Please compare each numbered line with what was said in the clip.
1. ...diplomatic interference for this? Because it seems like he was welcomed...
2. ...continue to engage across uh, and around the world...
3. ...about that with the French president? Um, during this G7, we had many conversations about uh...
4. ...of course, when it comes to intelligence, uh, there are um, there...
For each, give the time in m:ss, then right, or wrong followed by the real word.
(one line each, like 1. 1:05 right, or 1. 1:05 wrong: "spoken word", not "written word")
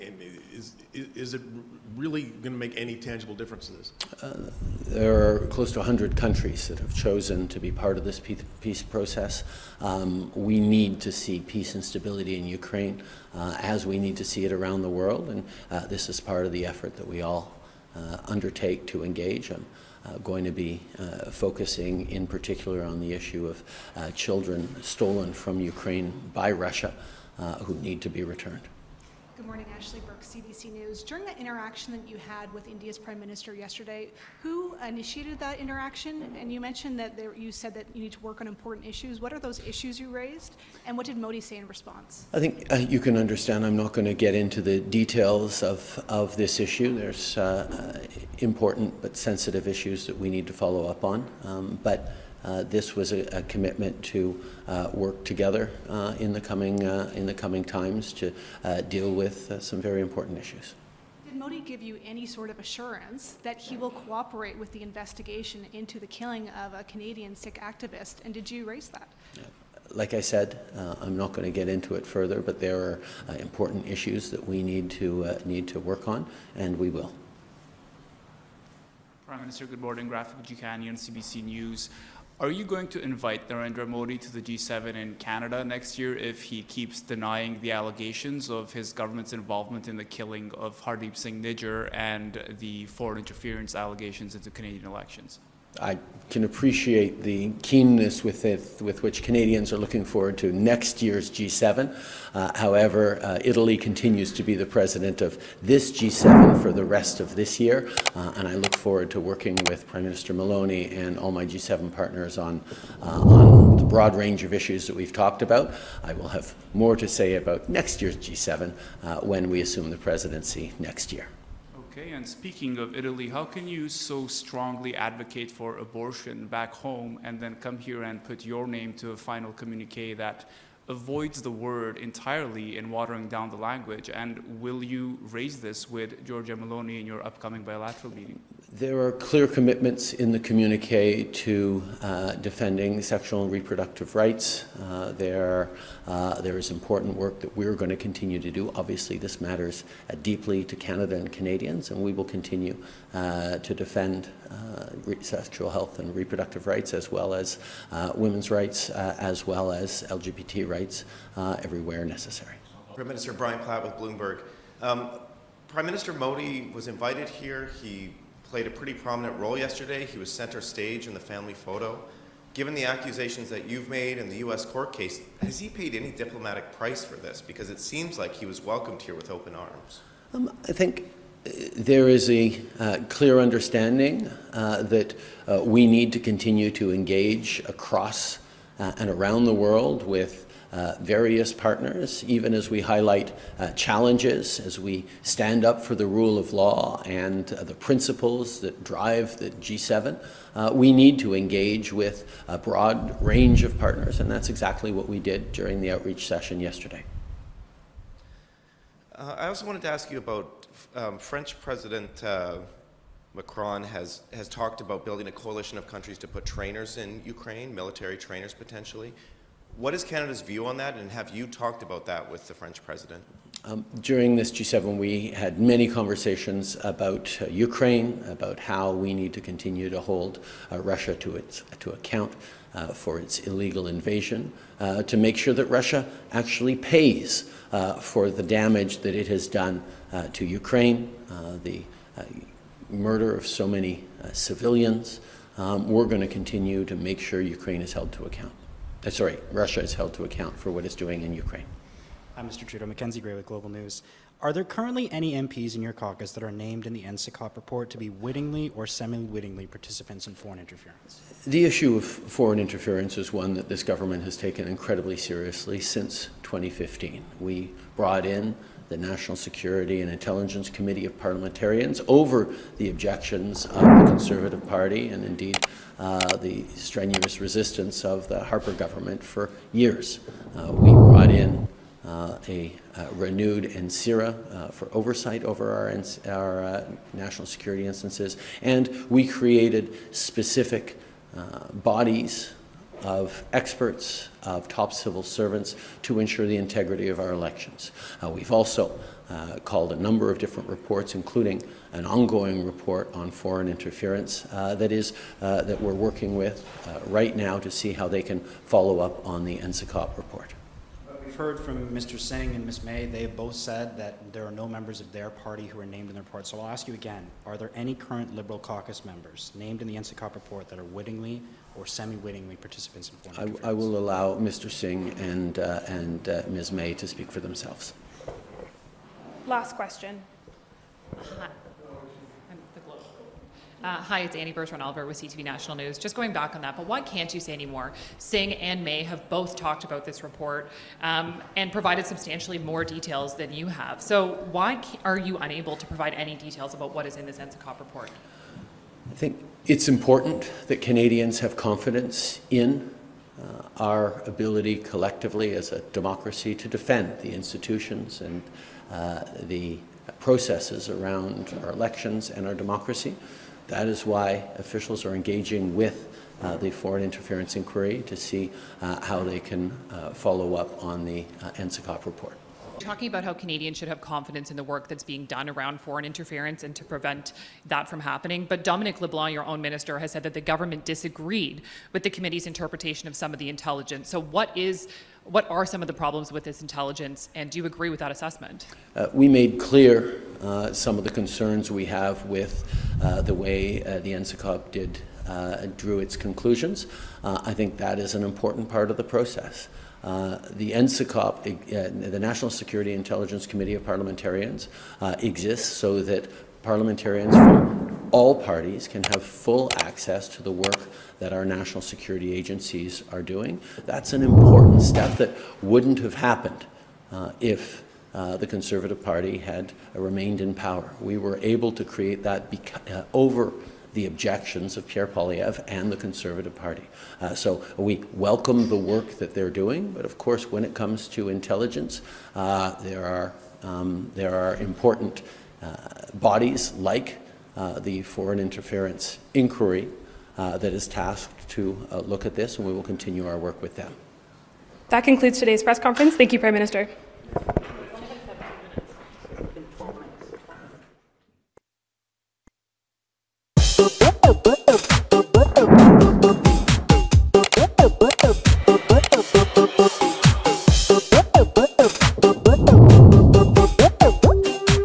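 1. 2:56 wrong: "price", not "interference"
2. 3:06 right
3. 3:41 right
4. 7:10 right.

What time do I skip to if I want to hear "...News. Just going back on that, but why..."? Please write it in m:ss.
5:35.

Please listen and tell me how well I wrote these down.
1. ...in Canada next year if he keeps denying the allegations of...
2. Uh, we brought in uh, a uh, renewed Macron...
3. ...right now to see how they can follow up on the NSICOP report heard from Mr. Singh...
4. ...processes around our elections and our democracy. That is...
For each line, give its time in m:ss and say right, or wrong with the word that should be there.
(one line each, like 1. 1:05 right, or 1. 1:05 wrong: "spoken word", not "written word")
1. 1:24 right
2. 4:40 wrong: "NSIRA", not "Macron"
3. 5:07 right
4. 6:00 right.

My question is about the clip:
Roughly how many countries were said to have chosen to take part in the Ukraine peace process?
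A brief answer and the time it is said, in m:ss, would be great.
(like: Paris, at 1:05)
close to 100, at 0:05.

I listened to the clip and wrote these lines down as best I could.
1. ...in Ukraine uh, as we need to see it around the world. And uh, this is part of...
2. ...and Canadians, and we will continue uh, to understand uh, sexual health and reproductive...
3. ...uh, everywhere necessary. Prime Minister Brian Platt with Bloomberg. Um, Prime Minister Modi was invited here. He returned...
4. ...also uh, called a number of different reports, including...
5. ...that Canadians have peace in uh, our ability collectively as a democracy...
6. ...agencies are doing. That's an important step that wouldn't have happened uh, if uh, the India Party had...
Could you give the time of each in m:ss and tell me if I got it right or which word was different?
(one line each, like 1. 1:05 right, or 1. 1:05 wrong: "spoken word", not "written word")
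1. 0:12 right
2. 2:31 wrong: "defend", not "understand"
3. 2:41 wrong: "played", not "returned"
4. 4:58 right
5. 5:50 wrong: "confidence", not "peace"
6. 6:52 wrong: "Conservative", not "India".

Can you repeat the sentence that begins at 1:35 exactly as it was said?
I can appreciate the keenness with, it, with which Canadians are looking forward to next year's G7.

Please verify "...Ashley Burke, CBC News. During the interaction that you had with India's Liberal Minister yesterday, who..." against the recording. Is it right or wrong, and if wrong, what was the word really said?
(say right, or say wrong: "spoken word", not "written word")
wrong: "Prime", not "Liberal".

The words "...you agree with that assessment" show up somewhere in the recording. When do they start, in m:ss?
6:27.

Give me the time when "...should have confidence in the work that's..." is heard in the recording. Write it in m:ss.
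6:13.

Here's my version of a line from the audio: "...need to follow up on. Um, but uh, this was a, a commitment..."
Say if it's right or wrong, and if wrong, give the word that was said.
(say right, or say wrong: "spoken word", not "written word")
right.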